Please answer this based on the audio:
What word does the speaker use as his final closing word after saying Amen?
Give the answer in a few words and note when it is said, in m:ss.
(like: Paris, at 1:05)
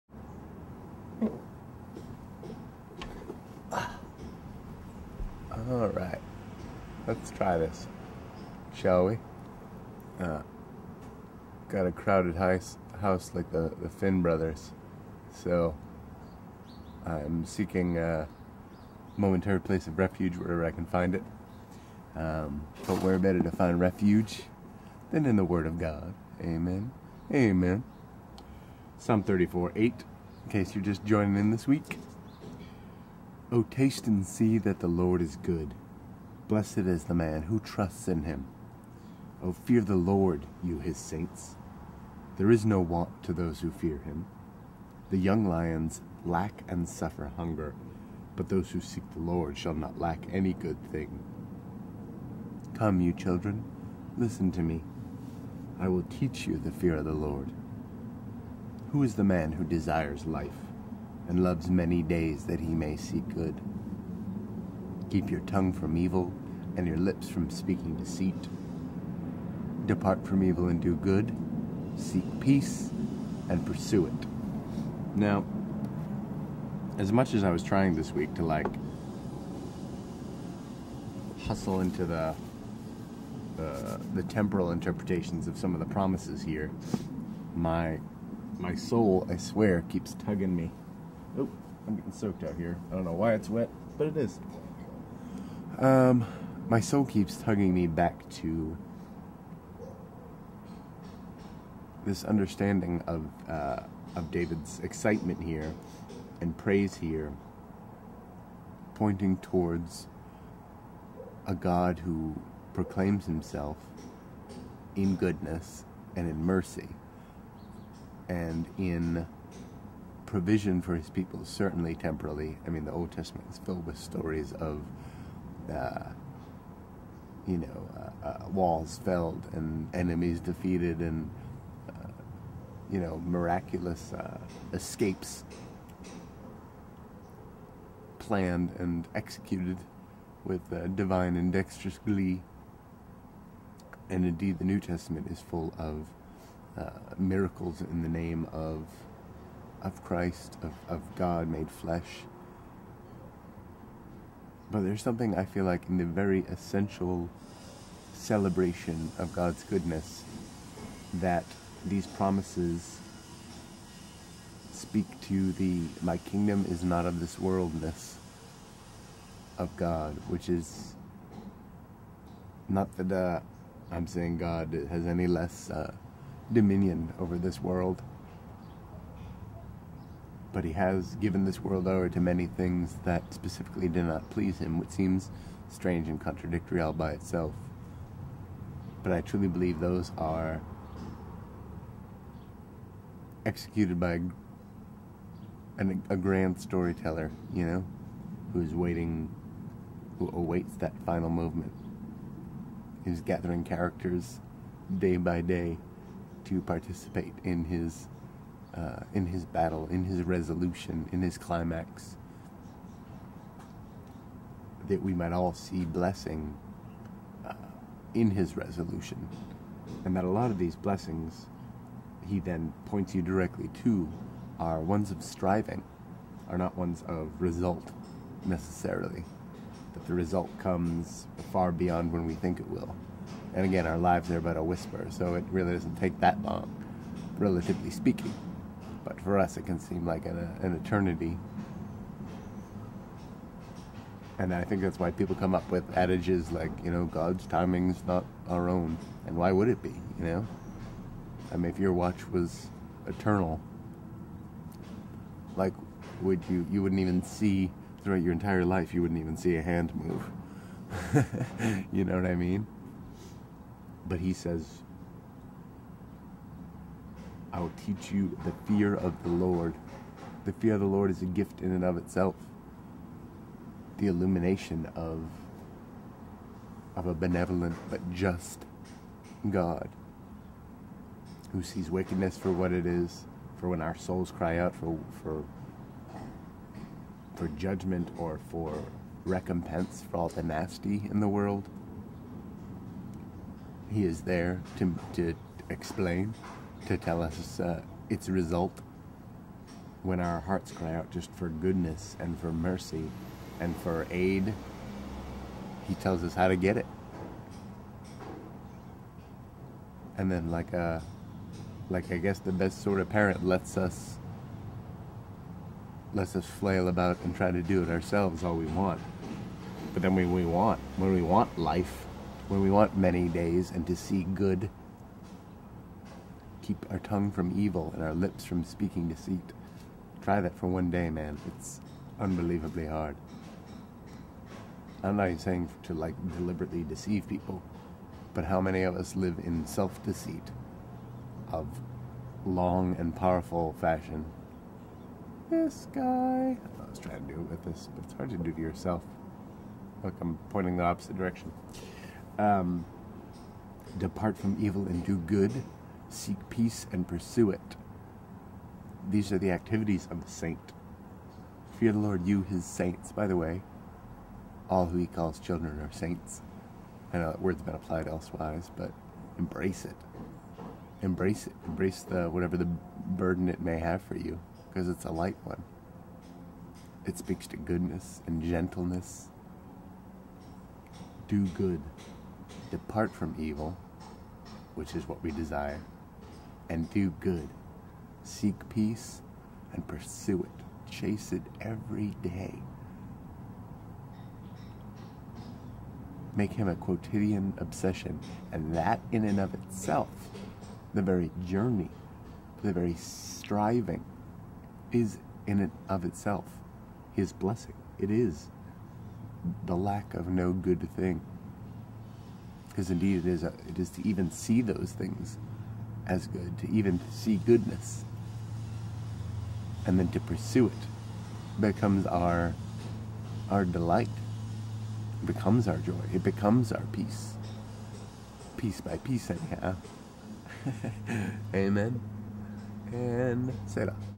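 Selah, at 7:13.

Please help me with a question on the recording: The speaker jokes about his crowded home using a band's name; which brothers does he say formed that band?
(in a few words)
the Finn brothers.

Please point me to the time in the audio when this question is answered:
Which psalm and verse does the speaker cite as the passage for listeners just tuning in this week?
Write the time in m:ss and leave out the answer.
0:28.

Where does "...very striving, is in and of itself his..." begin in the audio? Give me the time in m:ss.
6:42.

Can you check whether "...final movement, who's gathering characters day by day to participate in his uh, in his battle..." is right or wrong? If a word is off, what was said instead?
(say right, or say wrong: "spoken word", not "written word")
right.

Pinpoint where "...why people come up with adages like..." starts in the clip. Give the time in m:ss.
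4:04.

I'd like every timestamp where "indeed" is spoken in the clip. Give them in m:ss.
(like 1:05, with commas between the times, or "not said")
2:24, 6:52.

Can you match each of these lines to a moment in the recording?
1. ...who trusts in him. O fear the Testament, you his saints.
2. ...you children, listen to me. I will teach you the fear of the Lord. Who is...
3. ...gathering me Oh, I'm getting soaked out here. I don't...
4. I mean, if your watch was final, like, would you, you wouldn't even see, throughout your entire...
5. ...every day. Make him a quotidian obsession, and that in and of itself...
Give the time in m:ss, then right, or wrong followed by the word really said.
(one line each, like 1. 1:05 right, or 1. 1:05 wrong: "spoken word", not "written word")
1. 0:37 wrong: "Lord", not "Testament"
2. 0:53 right
3. 1:30 wrong: "tugging", not "gathering"
4. 4:11 wrong: "eternal", not "final"
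5. 6:31 right.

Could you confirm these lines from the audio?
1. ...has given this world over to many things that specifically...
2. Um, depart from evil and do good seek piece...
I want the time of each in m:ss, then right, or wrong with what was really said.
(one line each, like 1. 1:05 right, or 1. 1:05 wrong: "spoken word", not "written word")
1. 3:00 right
2. 5:52 wrong: "peace", not "piece".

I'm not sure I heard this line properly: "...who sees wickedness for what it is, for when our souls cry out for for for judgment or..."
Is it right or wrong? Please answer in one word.
right.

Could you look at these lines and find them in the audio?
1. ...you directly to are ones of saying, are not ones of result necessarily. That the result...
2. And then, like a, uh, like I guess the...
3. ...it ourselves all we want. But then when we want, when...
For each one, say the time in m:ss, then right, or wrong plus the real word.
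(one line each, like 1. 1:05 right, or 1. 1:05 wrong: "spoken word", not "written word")
1. 3:43 wrong: "striving", not "saying"
2. 5:10 right
3. 5:17 right.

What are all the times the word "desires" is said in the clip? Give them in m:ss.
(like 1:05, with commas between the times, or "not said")
0:59, 6:25.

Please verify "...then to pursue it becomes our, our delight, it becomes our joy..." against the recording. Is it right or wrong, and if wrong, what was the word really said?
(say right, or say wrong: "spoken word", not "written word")
right.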